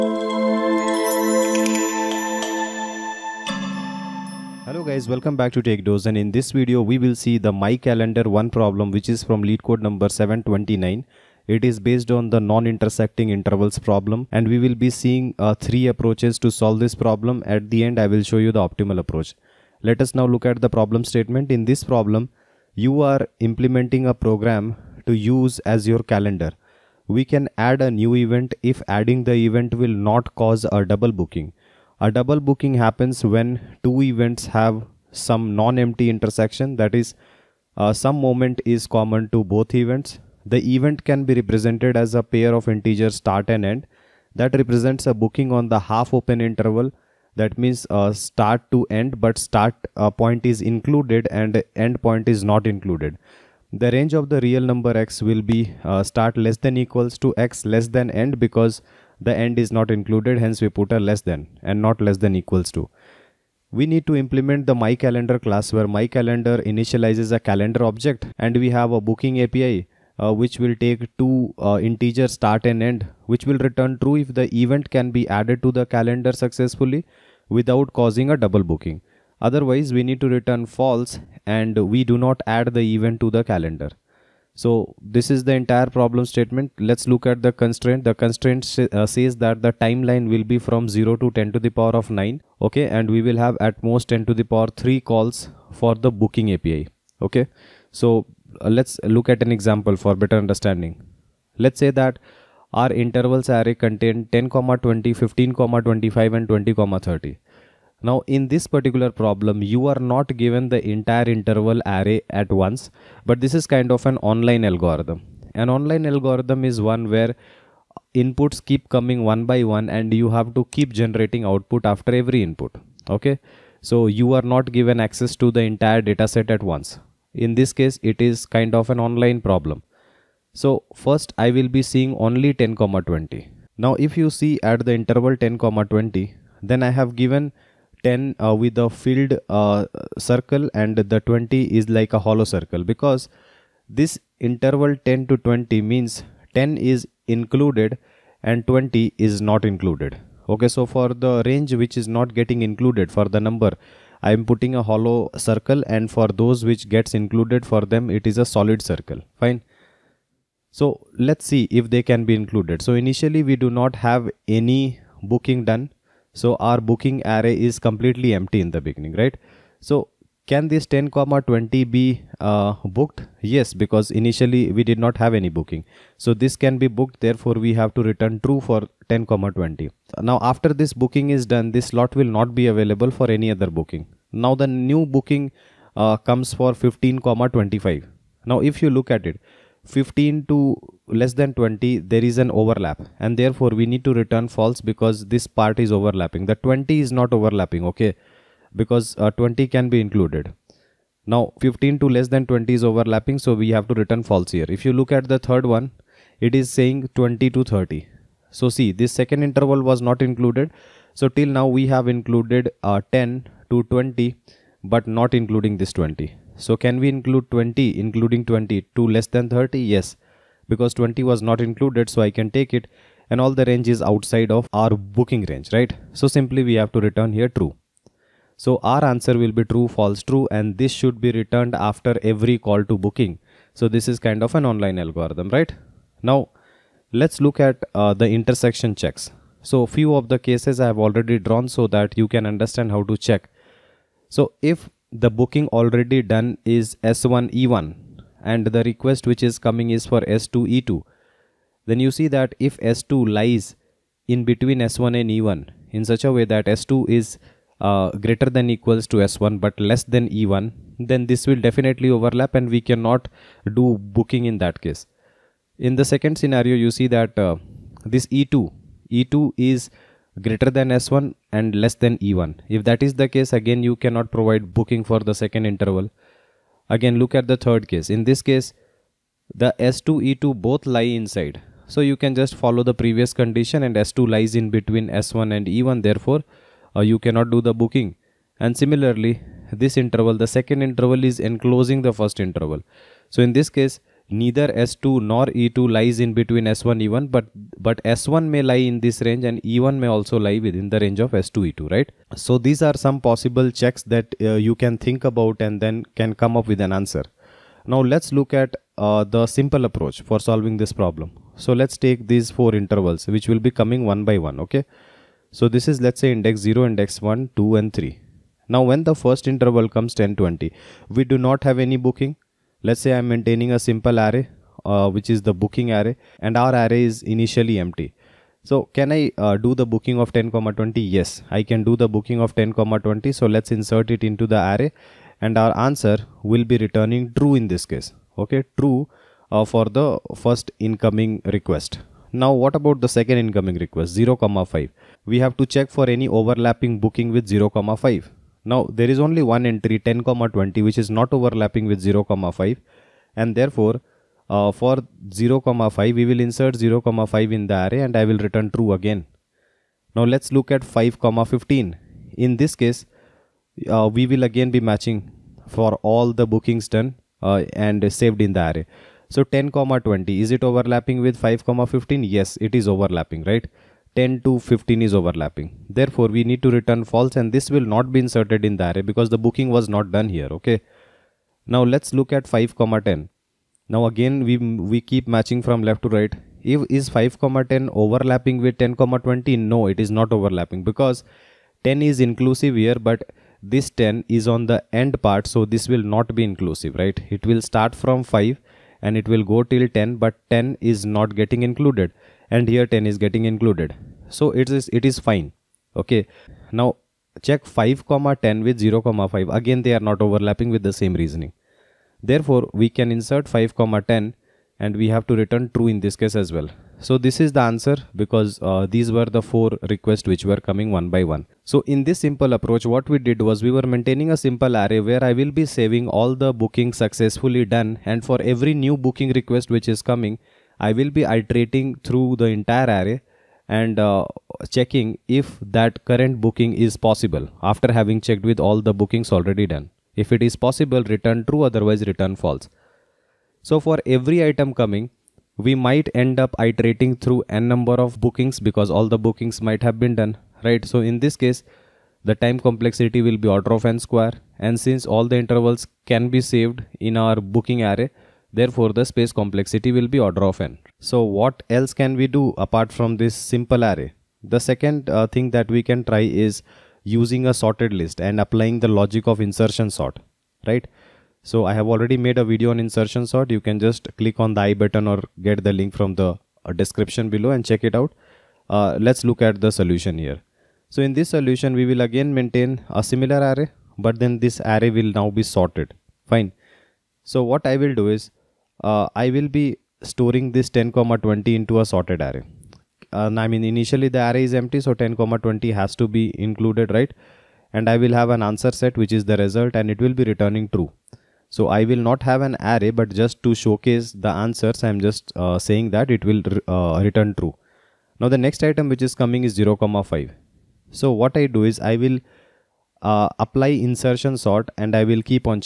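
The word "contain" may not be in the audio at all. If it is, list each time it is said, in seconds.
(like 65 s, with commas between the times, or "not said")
103 s.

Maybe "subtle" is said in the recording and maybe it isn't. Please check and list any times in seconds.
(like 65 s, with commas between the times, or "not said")
not said.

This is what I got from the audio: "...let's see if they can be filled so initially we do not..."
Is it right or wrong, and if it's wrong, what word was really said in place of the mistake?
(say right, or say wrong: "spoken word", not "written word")
wrong: "included", not "filled".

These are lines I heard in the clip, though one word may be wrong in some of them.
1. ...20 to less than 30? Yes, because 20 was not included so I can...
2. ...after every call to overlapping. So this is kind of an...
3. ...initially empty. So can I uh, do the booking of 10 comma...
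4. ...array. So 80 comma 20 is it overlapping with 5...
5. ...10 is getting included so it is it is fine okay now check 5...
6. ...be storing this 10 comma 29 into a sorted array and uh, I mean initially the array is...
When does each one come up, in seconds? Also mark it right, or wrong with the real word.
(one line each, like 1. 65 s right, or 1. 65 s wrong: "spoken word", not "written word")
1. 218 s right
2. 231 s wrong: "booking", not "overlapping"
3. 327 s right
4. 368 s wrong: "10", not "80"
5. 402 s right
6. 489 s wrong: "20", not "29".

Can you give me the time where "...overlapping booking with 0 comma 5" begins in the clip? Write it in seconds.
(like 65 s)
346 s.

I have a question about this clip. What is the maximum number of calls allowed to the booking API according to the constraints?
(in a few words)
10 to the power 3.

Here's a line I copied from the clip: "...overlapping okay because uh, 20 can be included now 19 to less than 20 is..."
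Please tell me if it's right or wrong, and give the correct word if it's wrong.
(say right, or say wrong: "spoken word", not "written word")
wrong: "15", not "19".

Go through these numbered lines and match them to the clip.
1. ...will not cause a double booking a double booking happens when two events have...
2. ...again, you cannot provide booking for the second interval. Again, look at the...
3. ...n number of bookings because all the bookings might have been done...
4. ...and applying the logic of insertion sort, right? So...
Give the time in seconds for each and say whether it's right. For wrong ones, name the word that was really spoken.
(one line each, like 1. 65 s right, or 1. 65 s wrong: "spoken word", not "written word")
1. 29 s right
2. 273 s right
3. 447 s right
4. 468 s right.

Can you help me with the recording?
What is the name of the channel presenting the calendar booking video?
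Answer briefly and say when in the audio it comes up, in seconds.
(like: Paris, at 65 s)
TechDose, at 5 s.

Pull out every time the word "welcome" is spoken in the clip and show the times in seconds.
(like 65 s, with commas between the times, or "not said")
5 s.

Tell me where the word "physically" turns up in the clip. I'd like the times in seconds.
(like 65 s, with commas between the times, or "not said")
not said.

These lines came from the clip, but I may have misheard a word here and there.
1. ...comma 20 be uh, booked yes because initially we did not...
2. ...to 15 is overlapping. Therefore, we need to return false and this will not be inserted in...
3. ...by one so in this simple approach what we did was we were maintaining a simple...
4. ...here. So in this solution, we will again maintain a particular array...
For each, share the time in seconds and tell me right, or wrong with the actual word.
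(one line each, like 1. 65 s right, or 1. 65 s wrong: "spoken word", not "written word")
1. 171 s right
2. 374 s right
3. 421 s right
4. 480 s wrong: "similar", not "particular".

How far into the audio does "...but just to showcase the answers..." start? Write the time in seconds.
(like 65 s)
502 s.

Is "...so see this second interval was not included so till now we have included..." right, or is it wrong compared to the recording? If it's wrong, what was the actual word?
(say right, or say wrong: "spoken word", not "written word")
right.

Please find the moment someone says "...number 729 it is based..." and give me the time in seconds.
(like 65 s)
9 s.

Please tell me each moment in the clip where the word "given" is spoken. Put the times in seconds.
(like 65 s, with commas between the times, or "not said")
110 s, 124 s, 137 s.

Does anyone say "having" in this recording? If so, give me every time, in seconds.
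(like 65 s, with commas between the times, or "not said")
437 s.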